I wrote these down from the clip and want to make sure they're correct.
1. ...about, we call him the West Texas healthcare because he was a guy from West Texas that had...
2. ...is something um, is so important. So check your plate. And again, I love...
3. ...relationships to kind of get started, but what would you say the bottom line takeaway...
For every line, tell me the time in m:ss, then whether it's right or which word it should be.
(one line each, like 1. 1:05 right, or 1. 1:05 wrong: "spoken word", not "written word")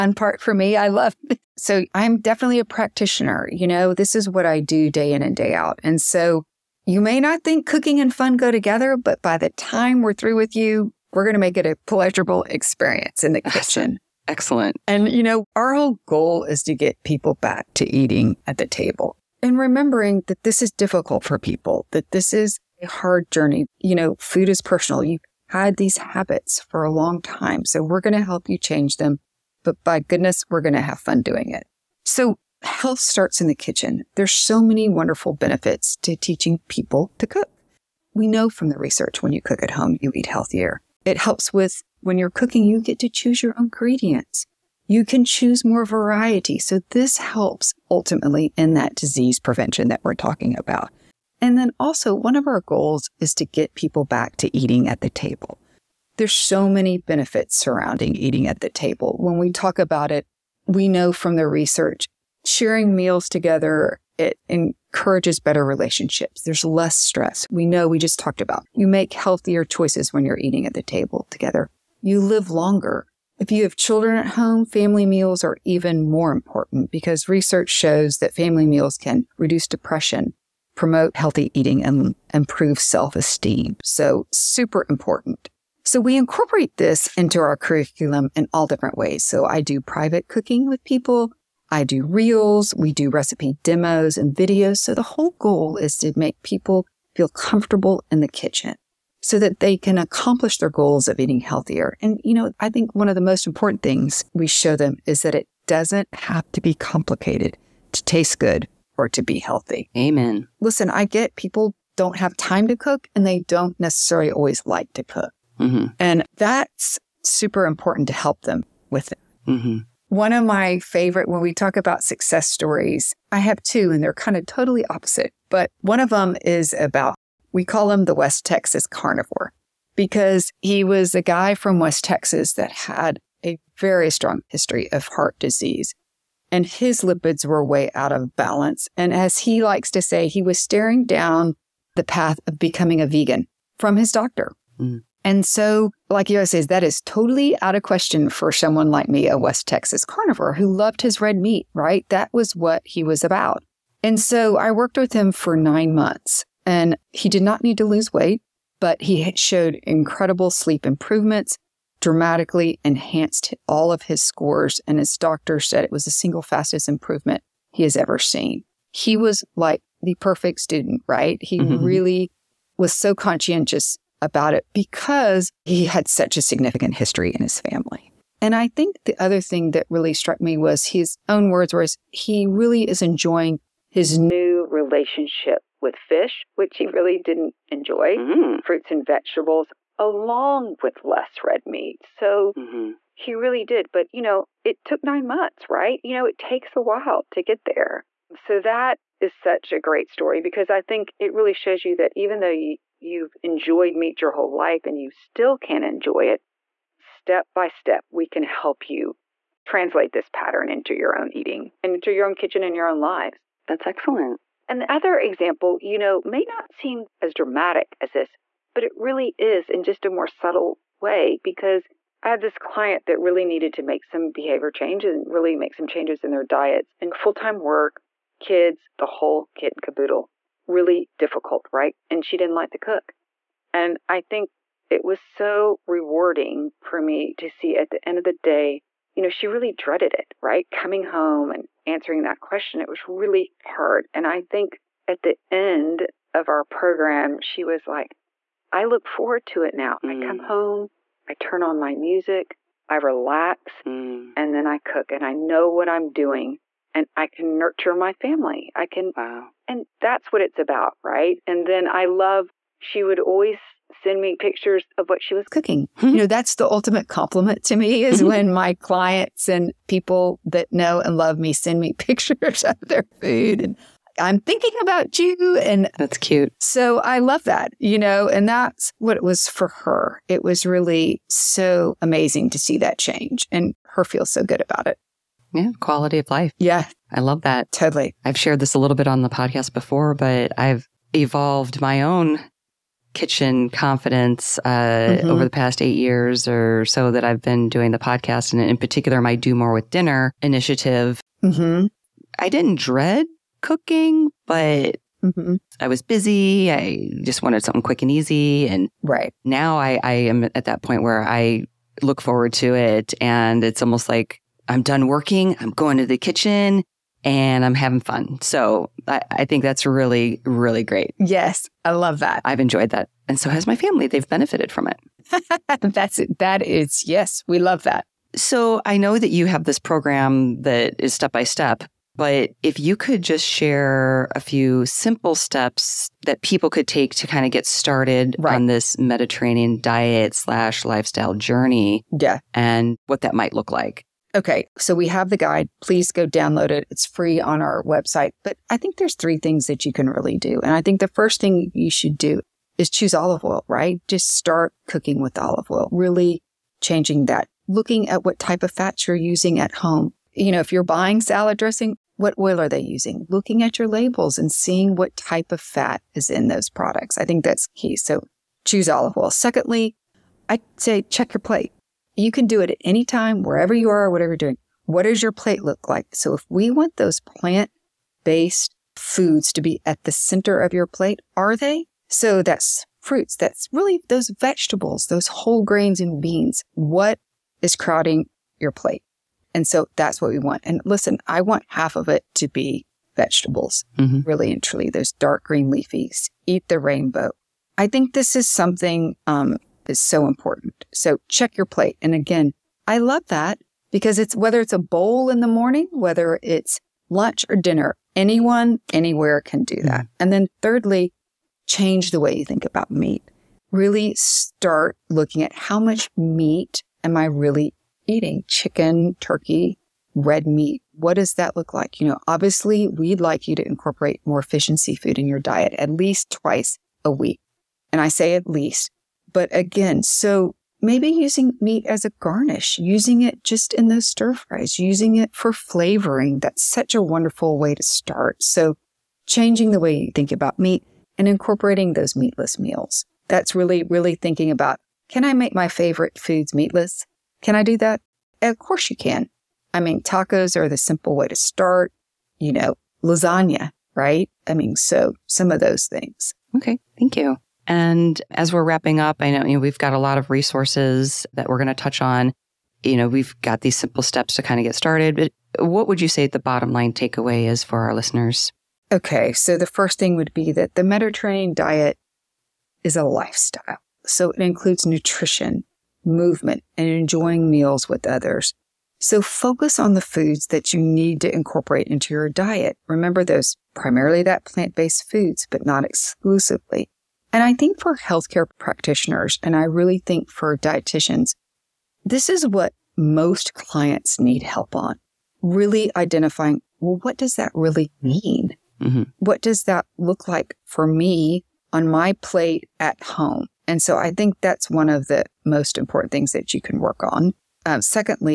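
1. 2:06 wrong: "carnivore", not "healthcare"
2. 6:38 right
3. 7:44 wrong: "steps", not "relationships".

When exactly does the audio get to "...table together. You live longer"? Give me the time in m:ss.
1:10.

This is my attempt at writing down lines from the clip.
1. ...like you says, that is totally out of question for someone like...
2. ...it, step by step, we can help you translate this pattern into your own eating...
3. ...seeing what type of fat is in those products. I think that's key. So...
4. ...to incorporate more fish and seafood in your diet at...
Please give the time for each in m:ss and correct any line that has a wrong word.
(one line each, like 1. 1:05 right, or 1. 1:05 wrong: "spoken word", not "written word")
1. 2:26 right
2. 3:26 right
3. 6:04 right
4. 7:03 right.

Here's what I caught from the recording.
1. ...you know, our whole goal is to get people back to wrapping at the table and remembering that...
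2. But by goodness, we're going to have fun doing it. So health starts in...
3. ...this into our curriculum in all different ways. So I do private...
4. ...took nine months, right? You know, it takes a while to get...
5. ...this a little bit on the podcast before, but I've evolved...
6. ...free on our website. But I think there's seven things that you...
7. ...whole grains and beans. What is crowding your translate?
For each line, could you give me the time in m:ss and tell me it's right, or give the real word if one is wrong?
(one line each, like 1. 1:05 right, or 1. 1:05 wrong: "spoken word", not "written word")
1. 0:15 wrong: "eating", not "wrapping"
2. 0:29 right
3. 1:26 right
4. 3:14 right
5. 4:48 right
6. 5:47 wrong: "three", not "seven"
7. 6:25 wrong: "plate", not "translate".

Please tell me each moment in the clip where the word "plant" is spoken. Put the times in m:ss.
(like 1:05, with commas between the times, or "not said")
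6:17, 8:04.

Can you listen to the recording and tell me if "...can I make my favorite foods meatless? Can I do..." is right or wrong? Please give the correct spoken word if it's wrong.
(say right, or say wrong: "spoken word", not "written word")
right.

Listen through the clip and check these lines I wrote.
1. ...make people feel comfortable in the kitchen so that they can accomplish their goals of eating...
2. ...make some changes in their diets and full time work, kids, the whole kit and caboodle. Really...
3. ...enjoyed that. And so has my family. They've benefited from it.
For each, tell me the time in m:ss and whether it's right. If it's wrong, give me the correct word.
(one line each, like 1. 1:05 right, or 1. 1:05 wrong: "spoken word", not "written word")
1. 1:36 right
2. 3:45 right
3. 5:22 right.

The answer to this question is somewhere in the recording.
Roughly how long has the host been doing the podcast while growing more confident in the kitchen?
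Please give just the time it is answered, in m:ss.
4:55.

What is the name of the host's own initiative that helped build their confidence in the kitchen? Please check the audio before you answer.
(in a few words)
Do More with Dinner.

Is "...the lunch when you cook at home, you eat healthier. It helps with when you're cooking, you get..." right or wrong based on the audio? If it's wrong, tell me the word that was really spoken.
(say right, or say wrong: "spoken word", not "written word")
wrong: "research", not "lunch".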